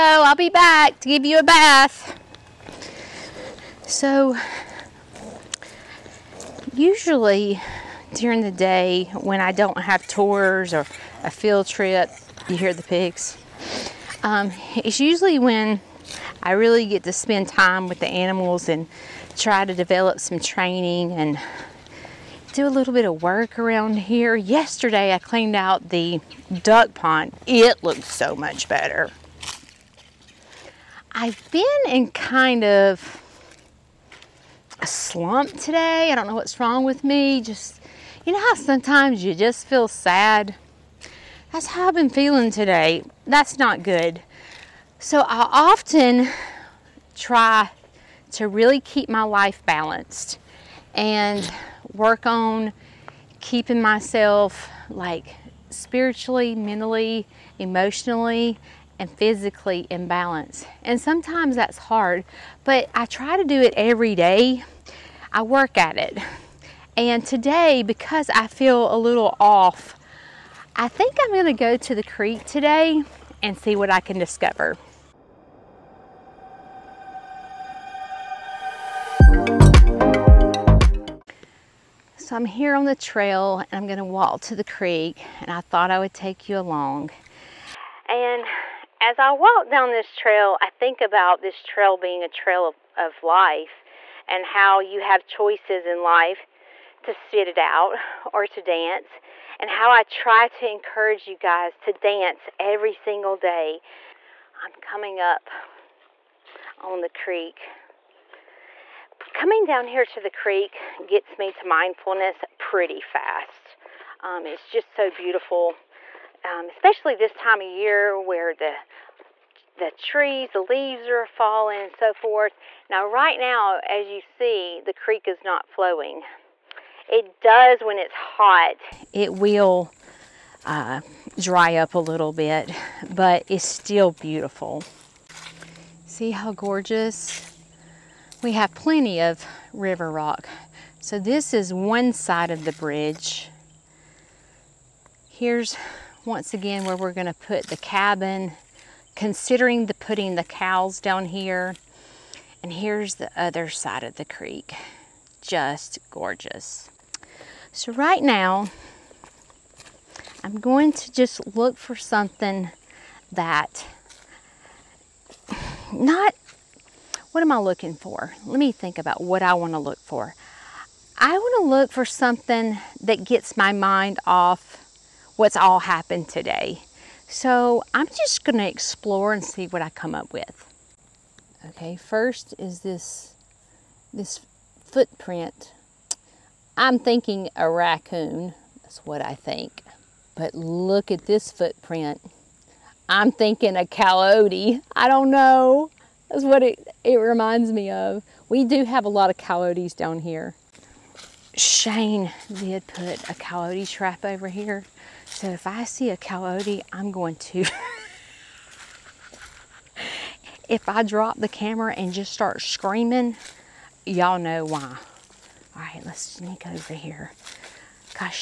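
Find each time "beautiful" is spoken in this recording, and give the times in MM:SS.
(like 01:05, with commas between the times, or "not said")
01:55, 02:14.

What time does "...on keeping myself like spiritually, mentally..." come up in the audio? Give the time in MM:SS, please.
00:52.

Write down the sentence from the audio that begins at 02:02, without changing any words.
Now right now, as you see, the creek is not flowing.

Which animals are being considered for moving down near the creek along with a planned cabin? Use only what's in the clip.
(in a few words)
Cows.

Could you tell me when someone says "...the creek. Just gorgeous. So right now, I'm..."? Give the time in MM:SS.
02:34.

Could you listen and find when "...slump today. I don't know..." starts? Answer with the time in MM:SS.
00:34.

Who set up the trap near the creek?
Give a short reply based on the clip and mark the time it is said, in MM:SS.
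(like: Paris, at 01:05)
Shane, at 03:21.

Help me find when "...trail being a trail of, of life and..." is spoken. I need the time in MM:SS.
01:31.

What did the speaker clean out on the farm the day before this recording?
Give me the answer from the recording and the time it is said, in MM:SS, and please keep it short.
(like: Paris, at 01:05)
The duck pond, at 00:26.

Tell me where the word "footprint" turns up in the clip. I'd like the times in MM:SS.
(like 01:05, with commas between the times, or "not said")
03:04, 03:11.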